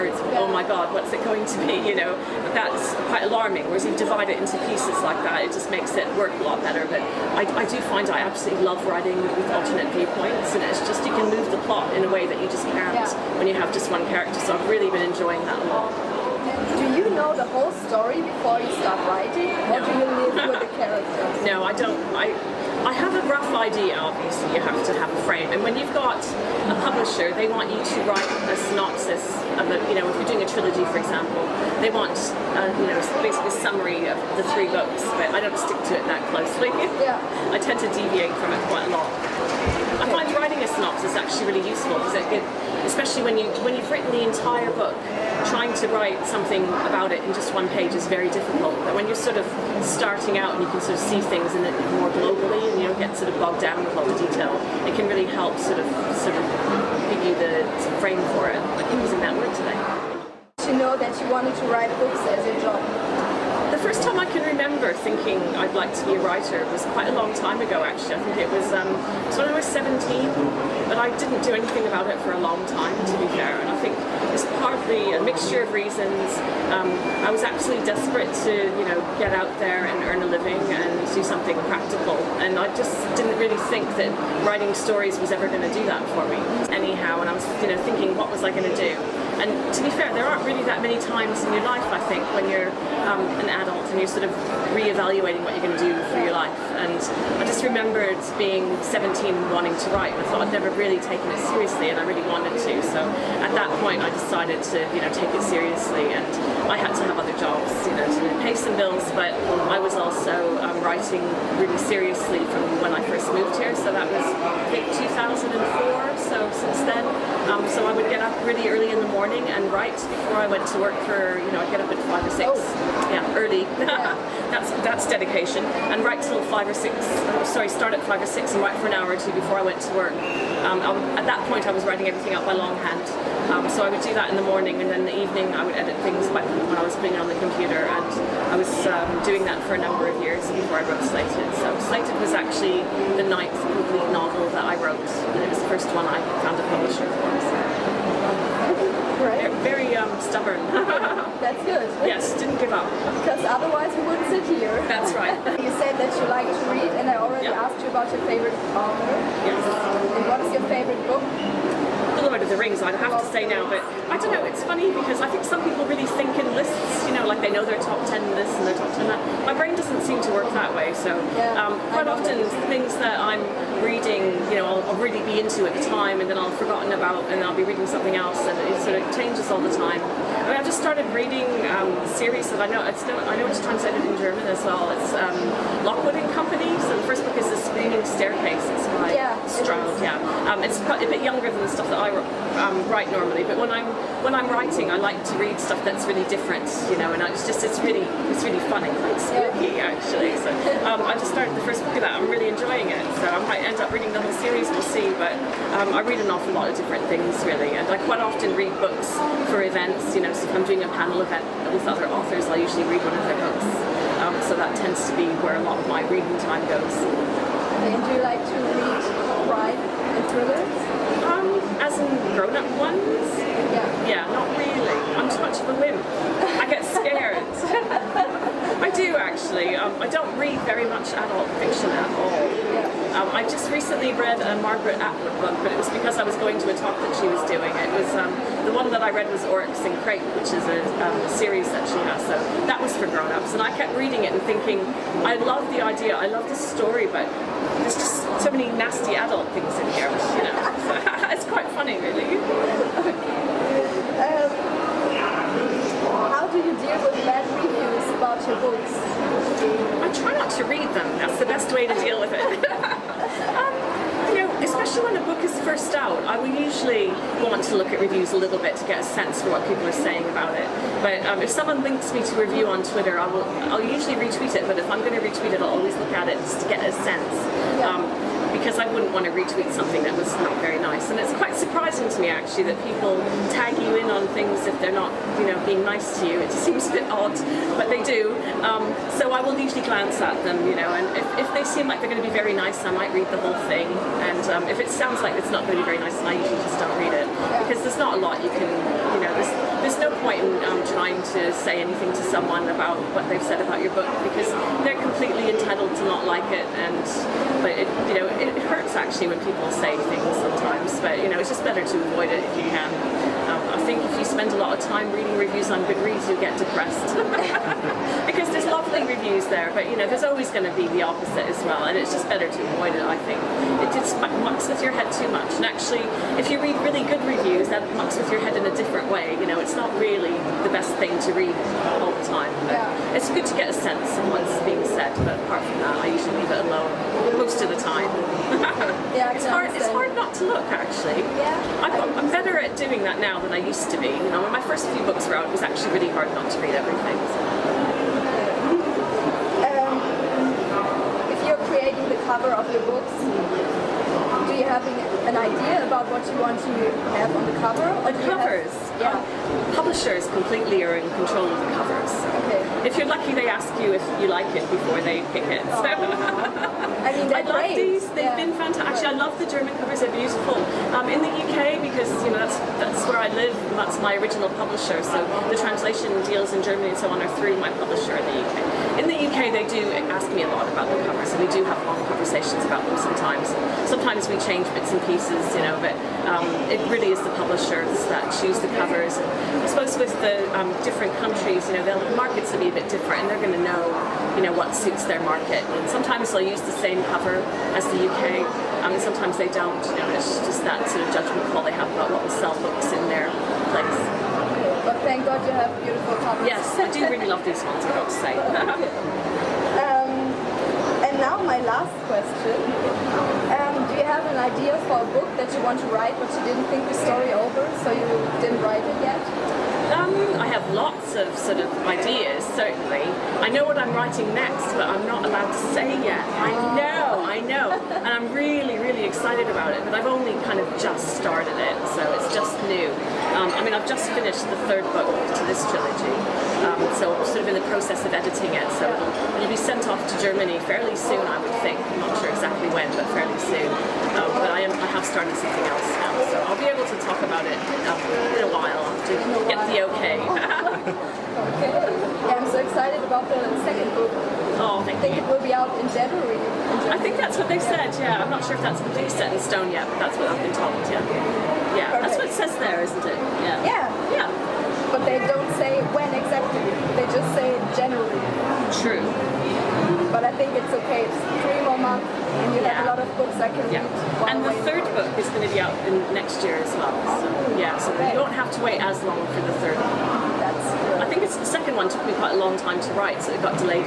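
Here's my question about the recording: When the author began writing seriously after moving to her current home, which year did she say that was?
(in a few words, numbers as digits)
2004.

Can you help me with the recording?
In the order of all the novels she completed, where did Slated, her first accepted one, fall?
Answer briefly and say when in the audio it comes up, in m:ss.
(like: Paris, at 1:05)
9th, at 2:23.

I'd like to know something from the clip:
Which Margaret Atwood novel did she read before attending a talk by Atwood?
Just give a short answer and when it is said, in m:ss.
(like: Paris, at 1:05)
Oryx and Crake, at 3:59.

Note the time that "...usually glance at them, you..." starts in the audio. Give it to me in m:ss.
4:49.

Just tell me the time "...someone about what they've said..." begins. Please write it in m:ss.
5:02.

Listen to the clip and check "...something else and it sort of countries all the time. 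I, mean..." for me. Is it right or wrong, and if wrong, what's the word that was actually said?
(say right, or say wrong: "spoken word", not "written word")
wrong: "changes", not "countries".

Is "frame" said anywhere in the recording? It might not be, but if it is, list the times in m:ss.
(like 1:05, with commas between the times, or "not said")
0:25, 0:57.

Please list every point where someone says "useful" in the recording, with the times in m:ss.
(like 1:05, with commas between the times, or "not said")
0:41.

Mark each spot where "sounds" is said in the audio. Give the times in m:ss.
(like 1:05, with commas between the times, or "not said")
4:54.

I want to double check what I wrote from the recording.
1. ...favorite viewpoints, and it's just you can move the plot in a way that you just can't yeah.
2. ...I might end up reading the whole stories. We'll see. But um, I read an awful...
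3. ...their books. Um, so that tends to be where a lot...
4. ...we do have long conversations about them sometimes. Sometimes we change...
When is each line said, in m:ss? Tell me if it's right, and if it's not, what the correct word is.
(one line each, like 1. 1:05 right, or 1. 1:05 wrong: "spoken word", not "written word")
1. 0:09 wrong: "alternate", not "favorite"
2. 3:23 wrong: "series", not "stories"
3. 3:33 right
4. 6:21 right.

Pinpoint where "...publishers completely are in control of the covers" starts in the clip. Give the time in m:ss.
5:59.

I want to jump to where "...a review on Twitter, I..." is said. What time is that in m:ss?
4:32.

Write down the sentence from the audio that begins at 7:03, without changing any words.
I know what I'm writing next, but I'm not allowed to say yet.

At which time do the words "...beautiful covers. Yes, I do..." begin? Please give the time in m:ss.
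6:45.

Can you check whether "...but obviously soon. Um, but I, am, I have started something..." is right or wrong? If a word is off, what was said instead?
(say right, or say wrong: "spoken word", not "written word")
wrong: "fairly", not "obviously".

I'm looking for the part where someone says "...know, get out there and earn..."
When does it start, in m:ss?
1:18.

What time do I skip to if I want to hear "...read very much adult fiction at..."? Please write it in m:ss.
3:50.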